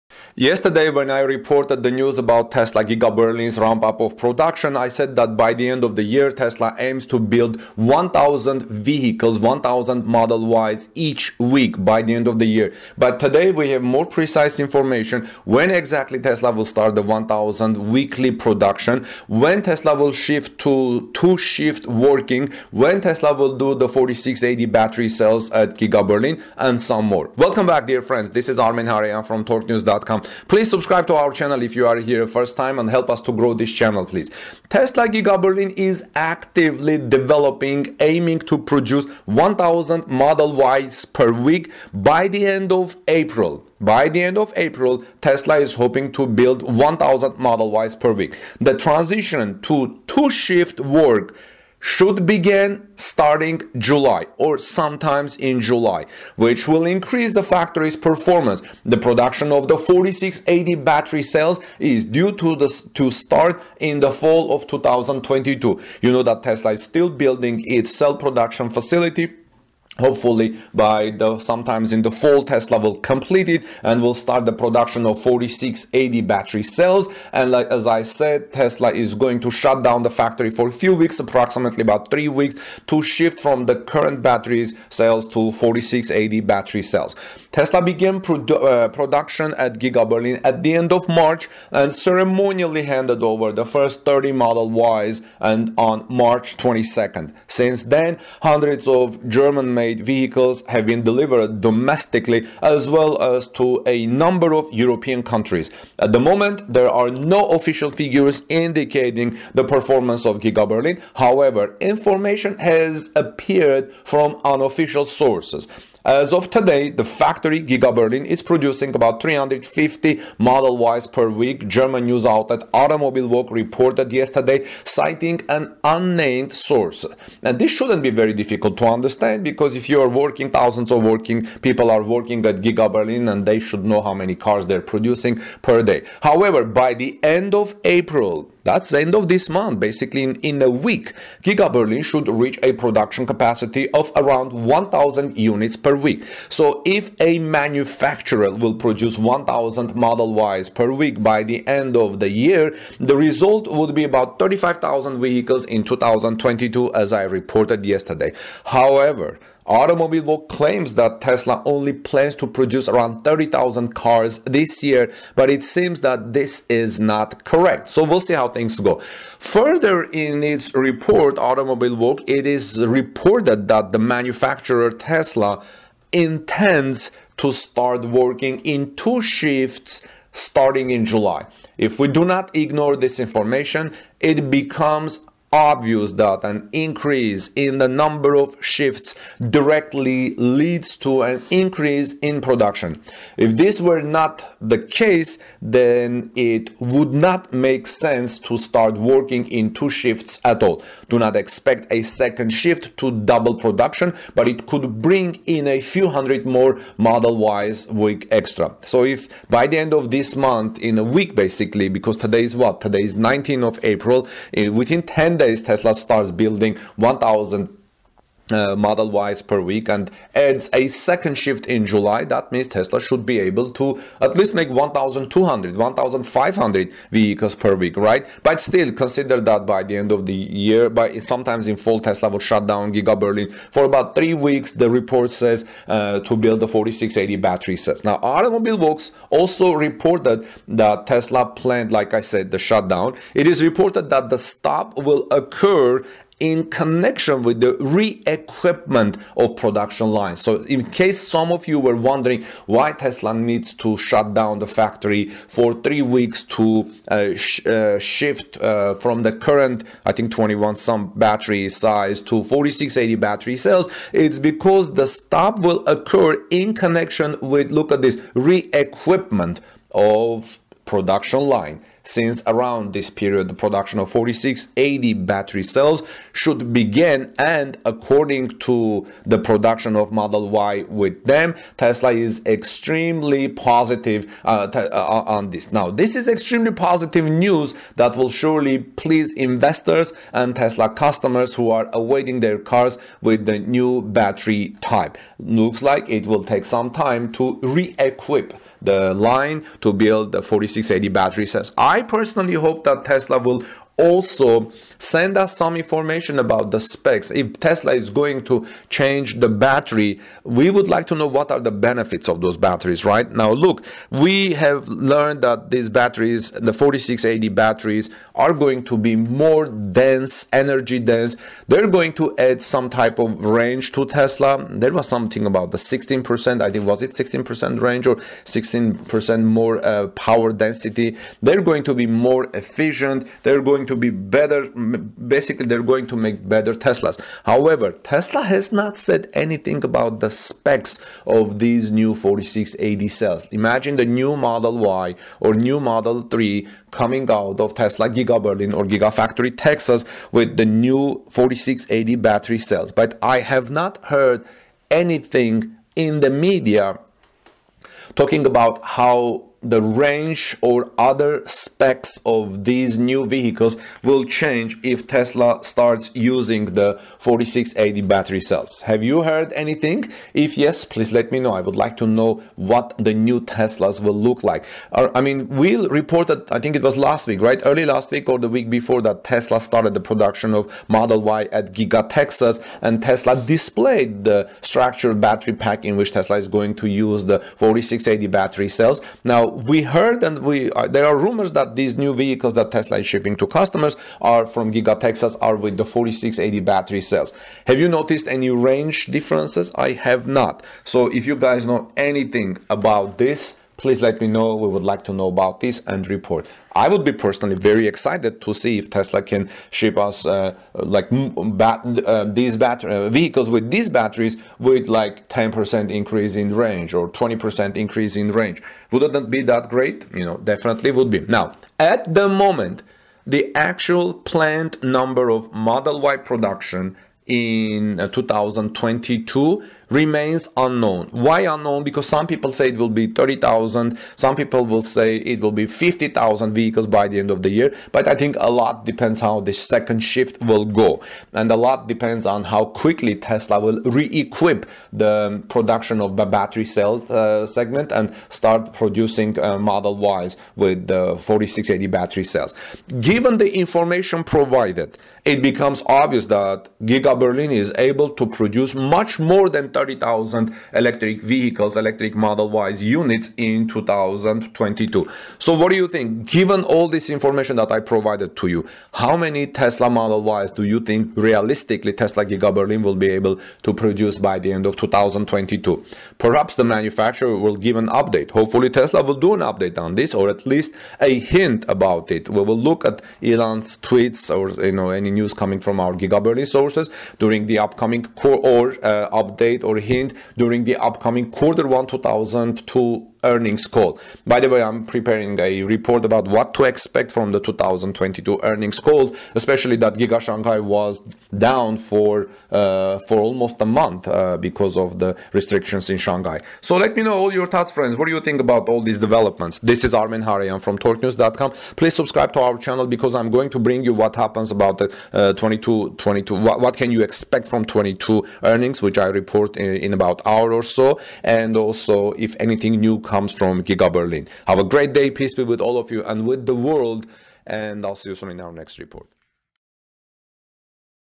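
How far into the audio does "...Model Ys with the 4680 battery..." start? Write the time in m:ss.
7:29.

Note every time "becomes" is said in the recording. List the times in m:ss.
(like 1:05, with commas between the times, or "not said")
3:04, 7:35.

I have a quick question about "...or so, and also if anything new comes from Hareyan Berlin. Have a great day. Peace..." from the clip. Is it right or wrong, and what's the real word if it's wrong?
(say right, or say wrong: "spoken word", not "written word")
wrong: "Giga", not "Hareyan".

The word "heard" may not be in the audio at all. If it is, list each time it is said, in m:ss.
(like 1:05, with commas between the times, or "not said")
5:54, 6:09, 6:29.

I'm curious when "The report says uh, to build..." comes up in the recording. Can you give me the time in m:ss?
3:54.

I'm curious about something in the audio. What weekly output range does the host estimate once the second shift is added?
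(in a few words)
1,200 to 1,500.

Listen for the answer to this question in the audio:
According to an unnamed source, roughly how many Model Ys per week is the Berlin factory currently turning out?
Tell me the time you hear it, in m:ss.
1:58.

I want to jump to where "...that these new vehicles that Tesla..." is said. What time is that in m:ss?
6:31.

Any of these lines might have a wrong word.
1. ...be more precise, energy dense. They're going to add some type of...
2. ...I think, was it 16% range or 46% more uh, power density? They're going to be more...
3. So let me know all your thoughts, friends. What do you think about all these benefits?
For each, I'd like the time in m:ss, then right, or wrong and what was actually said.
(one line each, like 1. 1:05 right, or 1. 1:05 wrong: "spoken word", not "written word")
1. 5:18 wrong: "dense", not "precise"
2. 5:26 wrong: "16", not "46"
3. 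8:26 wrong: "developments", not "benefits".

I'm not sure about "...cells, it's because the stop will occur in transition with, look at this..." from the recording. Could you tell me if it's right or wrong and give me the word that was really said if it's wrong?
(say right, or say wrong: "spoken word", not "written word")
wrong: "connection", not "transition".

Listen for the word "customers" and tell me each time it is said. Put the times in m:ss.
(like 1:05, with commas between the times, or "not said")
4:50, 6:33.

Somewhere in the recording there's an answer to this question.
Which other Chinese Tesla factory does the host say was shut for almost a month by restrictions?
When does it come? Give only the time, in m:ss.
8:19.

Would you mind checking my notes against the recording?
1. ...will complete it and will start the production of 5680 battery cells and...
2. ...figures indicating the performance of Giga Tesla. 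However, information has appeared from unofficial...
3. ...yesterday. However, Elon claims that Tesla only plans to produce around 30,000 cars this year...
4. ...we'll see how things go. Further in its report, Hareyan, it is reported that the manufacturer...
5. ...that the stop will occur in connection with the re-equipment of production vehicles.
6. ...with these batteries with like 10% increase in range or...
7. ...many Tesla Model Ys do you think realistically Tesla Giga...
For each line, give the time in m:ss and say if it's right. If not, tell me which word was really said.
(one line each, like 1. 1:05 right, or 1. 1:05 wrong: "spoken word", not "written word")
1. 1:12 wrong: "4680", not "5680"
2. 1:47 wrong: "Berlin", not "Tesla"
3. 2:37 wrong: "Automobile", not "Elon"
4. 2:48 wrong: "Automobilwoche", not "Hareyan"
5. 4:04 wrong: "lines", not "vehicles"
6. 6:53 right
7. 7:49 right.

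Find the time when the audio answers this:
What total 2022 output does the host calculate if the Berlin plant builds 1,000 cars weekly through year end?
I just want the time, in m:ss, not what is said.
2:34.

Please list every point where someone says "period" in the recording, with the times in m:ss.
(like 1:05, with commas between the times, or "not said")
4:33.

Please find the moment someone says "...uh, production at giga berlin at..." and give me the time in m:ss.
1:28.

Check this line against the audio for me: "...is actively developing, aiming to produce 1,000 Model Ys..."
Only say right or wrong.
right.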